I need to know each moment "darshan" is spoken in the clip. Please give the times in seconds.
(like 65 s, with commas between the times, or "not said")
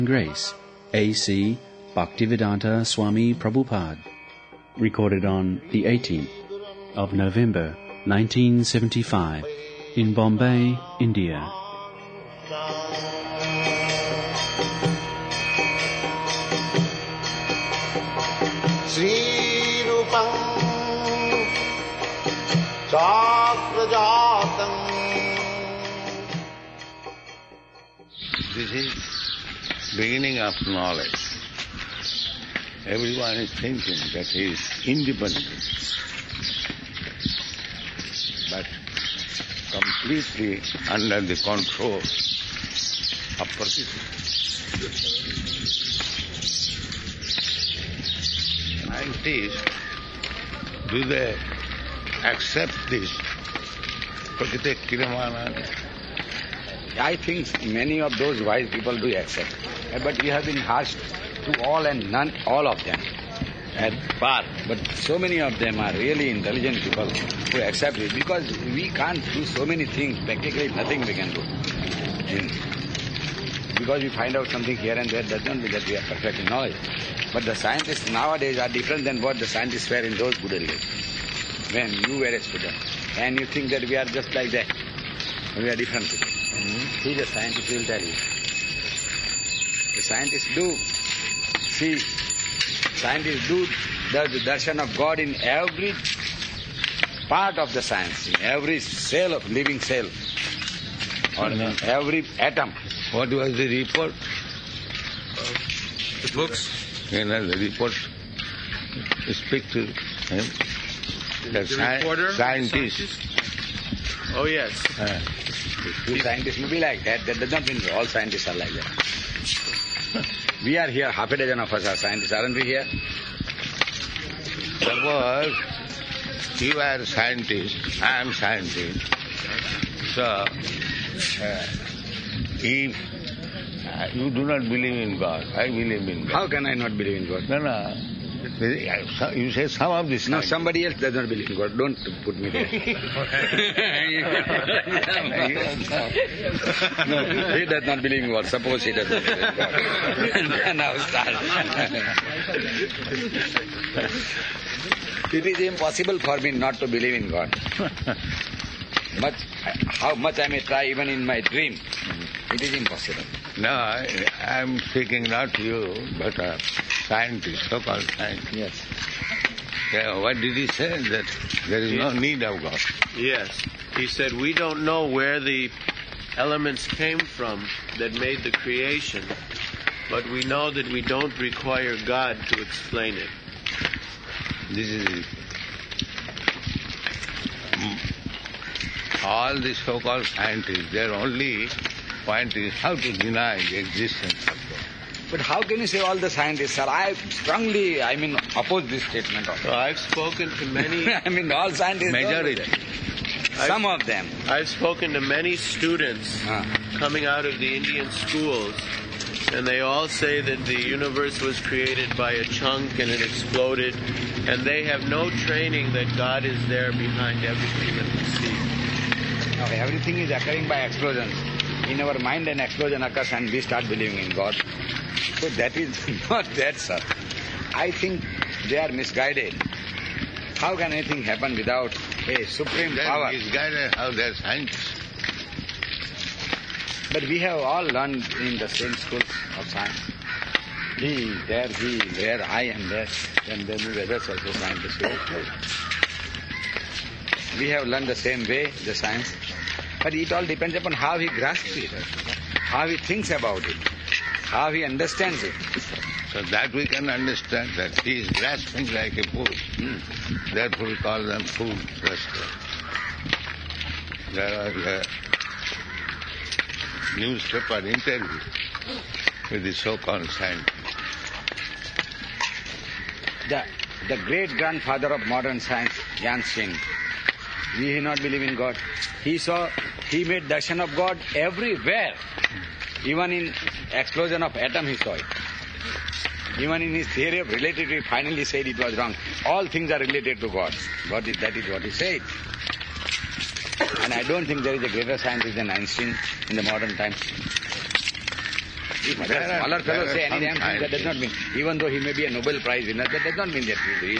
94 s, 280 s.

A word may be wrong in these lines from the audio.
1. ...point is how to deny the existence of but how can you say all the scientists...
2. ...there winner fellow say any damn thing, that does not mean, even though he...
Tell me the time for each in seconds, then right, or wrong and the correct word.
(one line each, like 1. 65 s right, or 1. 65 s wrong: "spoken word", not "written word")
1. 192 s right
2. 299 s wrong: "smaller", not "winner".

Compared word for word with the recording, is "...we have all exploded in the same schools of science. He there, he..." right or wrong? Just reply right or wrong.
wrong.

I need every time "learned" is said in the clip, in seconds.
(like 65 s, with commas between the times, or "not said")
237 s, 247 s.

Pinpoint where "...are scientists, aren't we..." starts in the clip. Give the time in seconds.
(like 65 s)
121 s.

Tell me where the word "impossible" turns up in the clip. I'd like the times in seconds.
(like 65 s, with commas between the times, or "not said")
155 s, 162 s.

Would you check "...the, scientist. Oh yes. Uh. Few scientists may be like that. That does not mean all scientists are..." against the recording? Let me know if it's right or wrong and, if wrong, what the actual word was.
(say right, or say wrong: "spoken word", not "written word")
right.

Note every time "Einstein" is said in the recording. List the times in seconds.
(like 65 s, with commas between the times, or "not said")
276 s, 295 s.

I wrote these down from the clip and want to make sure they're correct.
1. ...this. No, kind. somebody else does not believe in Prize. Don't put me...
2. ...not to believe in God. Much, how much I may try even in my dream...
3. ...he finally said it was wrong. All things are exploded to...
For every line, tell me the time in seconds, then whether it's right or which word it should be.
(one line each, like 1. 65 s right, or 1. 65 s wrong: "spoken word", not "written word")
1. 140 s wrong: "God", not "Prize"
2. 156 s right
3. 287 s wrong: "related", not "exploded".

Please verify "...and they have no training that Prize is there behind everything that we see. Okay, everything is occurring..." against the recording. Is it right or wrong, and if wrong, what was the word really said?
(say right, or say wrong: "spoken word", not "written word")
wrong: "God", not "Prize".